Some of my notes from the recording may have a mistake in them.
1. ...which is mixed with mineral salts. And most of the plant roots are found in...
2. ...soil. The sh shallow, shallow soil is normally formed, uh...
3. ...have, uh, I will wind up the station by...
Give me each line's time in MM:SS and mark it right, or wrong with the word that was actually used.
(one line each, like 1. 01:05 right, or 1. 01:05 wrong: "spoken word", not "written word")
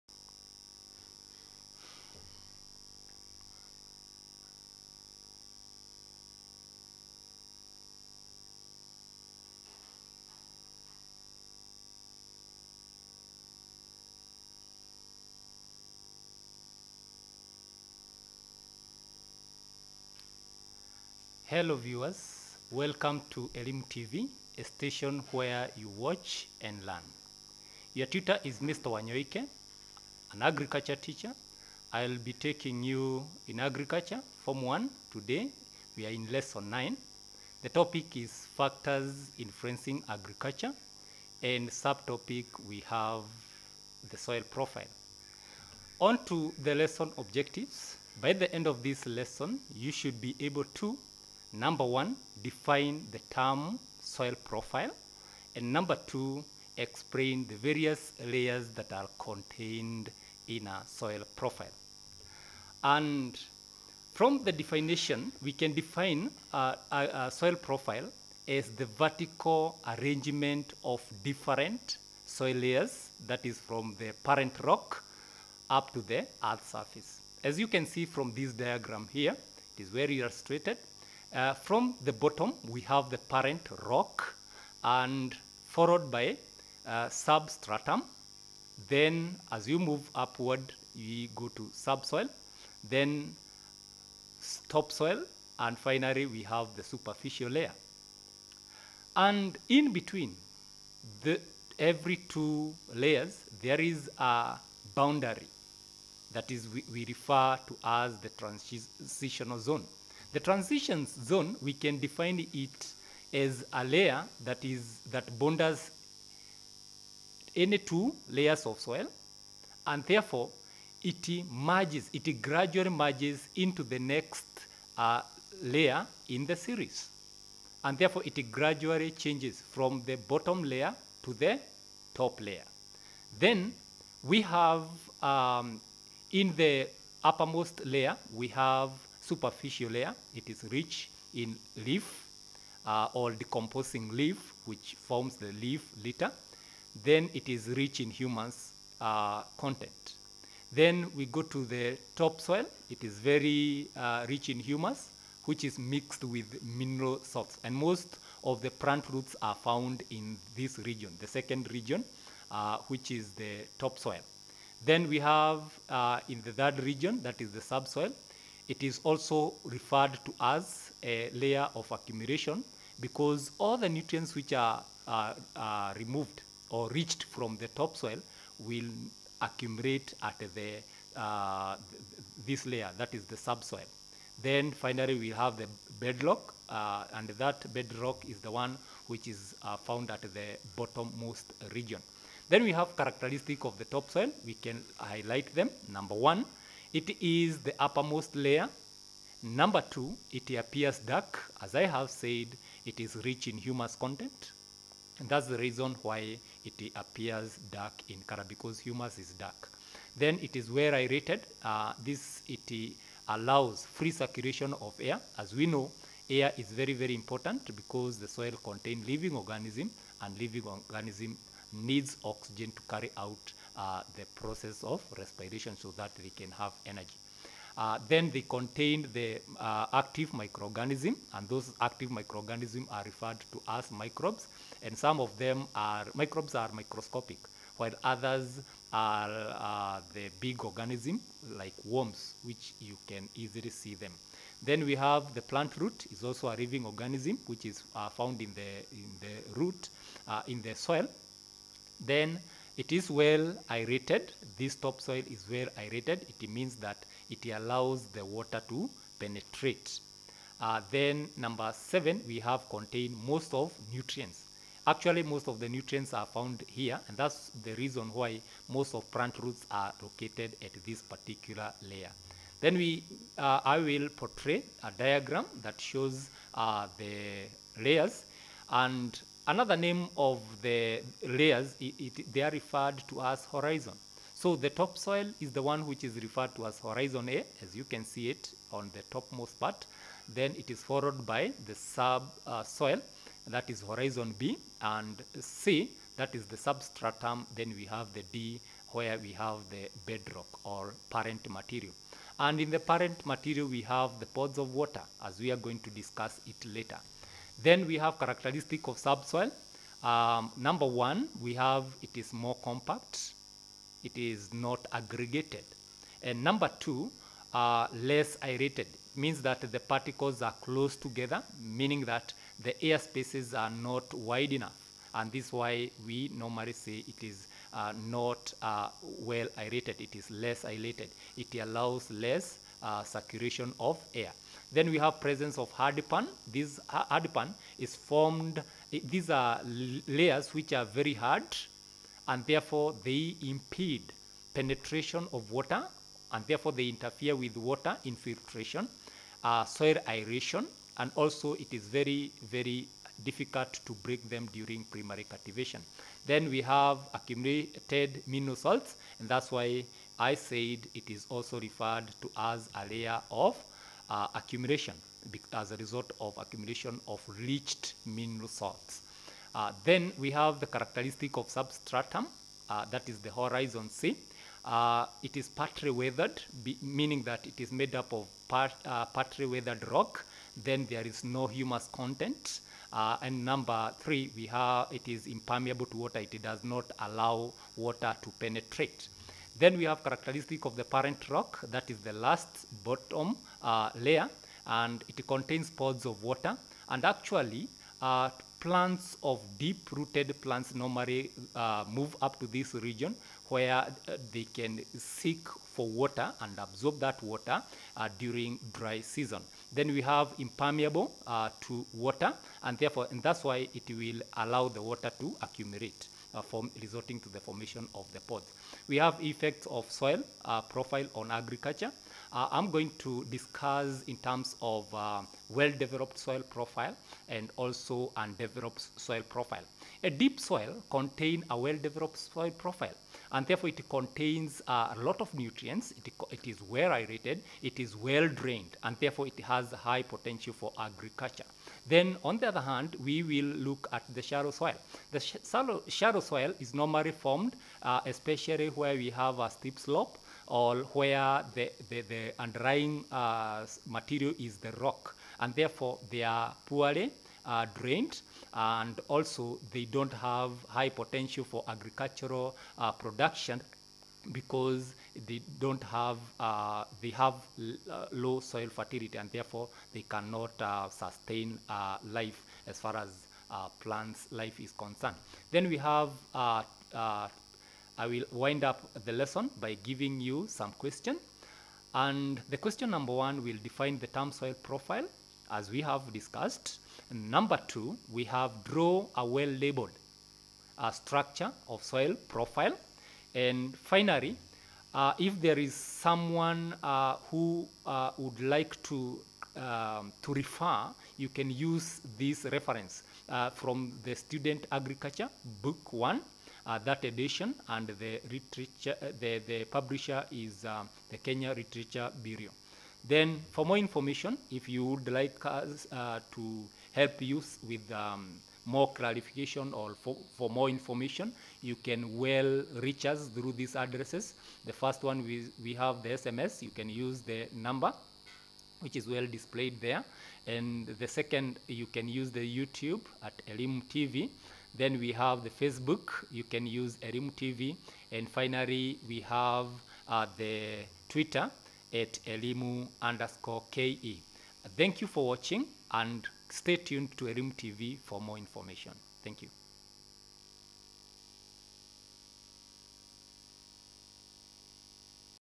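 1. 02:35 right
2. 07:24 right
3. 07:55 wrong: "lesson", not "station".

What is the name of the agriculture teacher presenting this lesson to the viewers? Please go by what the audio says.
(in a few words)
Mr. Wanyoike.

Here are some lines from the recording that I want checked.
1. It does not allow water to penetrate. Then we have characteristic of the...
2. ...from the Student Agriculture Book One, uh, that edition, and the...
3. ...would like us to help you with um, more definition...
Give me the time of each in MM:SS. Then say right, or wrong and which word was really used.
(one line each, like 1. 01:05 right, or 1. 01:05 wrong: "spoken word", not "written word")
1. 06:26 right
2. 08:23 right
3. 08:34 wrong: "clarification", not "definition".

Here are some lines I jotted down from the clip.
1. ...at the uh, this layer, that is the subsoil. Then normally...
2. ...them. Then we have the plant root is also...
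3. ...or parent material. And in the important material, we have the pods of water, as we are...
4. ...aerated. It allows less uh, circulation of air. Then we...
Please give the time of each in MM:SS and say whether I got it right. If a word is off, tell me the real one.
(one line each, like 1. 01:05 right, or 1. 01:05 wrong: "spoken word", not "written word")
1. 03:00 wrong: "finally", not "normally"
2. 04:03 right
3. 05:00 wrong: "parent", not "important"
4. 05:30 right.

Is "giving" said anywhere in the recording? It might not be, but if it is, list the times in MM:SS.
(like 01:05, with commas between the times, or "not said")
07:59.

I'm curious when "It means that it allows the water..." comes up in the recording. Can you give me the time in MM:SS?
04:16.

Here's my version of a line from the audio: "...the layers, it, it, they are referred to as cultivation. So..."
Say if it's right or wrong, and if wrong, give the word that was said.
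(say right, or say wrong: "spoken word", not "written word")
wrong: "horizon", not "cultivation".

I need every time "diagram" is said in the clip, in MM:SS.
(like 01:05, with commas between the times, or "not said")
01:18, 04:34.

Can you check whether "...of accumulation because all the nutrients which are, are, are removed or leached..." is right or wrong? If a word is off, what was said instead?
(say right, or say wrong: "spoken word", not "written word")
right.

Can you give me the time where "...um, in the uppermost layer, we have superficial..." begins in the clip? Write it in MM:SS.
02:15.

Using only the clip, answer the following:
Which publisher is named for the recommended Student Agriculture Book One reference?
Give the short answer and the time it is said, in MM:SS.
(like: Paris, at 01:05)
Kenya Literature Bureau, at 08:31.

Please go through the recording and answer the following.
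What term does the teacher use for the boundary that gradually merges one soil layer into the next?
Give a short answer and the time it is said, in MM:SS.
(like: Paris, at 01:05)
transitional zone, at 01:48.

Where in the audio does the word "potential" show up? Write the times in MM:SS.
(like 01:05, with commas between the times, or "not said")
07:20, 07:40.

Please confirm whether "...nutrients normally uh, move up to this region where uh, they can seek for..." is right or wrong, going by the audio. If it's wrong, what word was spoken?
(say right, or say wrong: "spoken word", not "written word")
wrong: "plants", not "nutrients".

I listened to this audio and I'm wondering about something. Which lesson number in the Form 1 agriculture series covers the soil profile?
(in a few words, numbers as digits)
Lesson 9.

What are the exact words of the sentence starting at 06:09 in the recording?
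Uh, then we have the characteristic of substratum, uh, that is the horizon C.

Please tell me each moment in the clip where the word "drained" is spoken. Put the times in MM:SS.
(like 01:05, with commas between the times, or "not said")
07:18, 07:37.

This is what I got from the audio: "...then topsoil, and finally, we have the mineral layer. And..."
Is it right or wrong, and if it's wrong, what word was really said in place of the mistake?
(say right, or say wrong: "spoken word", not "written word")
wrong: "superficial", not "mineral".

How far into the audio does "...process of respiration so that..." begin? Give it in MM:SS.
03:44.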